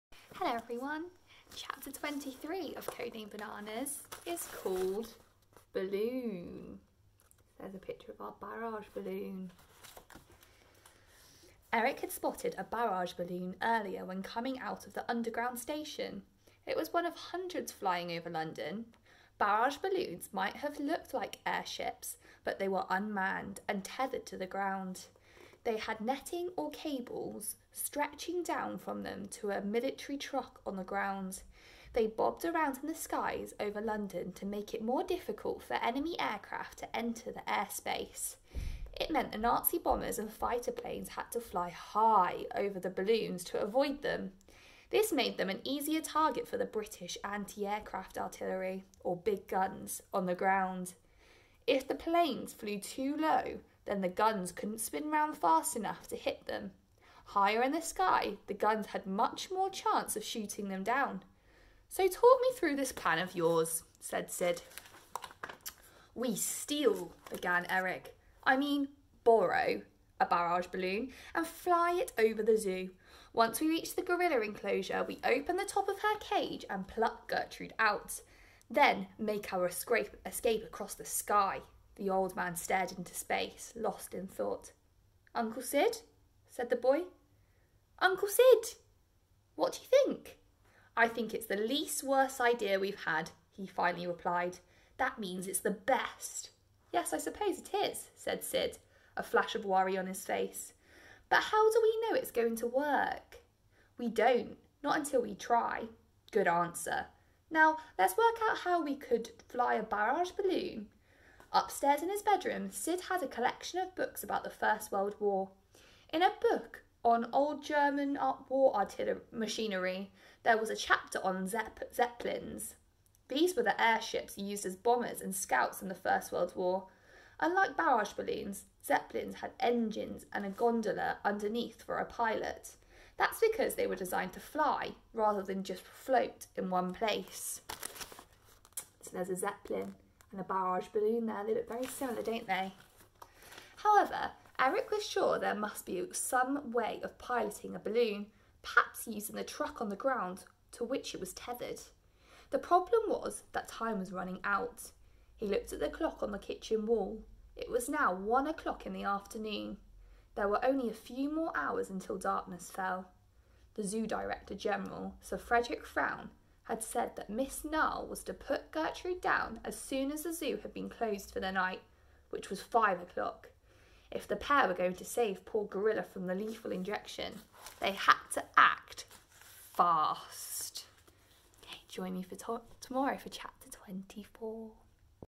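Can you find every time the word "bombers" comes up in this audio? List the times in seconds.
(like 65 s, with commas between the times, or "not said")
39 s, 124 s.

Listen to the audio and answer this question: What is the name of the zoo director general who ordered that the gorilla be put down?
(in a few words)
Sir Frederick Frown.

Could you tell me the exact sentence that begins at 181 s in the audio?
Okay, join me for to- tomorrow for chapter 24.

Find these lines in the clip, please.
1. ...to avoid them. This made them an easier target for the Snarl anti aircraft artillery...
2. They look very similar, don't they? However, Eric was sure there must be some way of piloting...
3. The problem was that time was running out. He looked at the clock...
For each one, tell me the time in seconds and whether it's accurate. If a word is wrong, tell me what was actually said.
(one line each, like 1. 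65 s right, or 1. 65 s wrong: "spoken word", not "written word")
1. 43 s wrong: "British", not "Snarl"
2. 141 s right
3. 152 s right.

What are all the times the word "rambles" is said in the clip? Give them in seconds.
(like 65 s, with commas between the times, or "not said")
not said.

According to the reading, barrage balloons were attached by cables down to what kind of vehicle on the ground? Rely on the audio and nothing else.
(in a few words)
A military truck.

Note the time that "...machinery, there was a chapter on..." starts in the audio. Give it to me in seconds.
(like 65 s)
119 s.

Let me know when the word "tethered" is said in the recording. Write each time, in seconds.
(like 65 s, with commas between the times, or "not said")
23 s, 151 s.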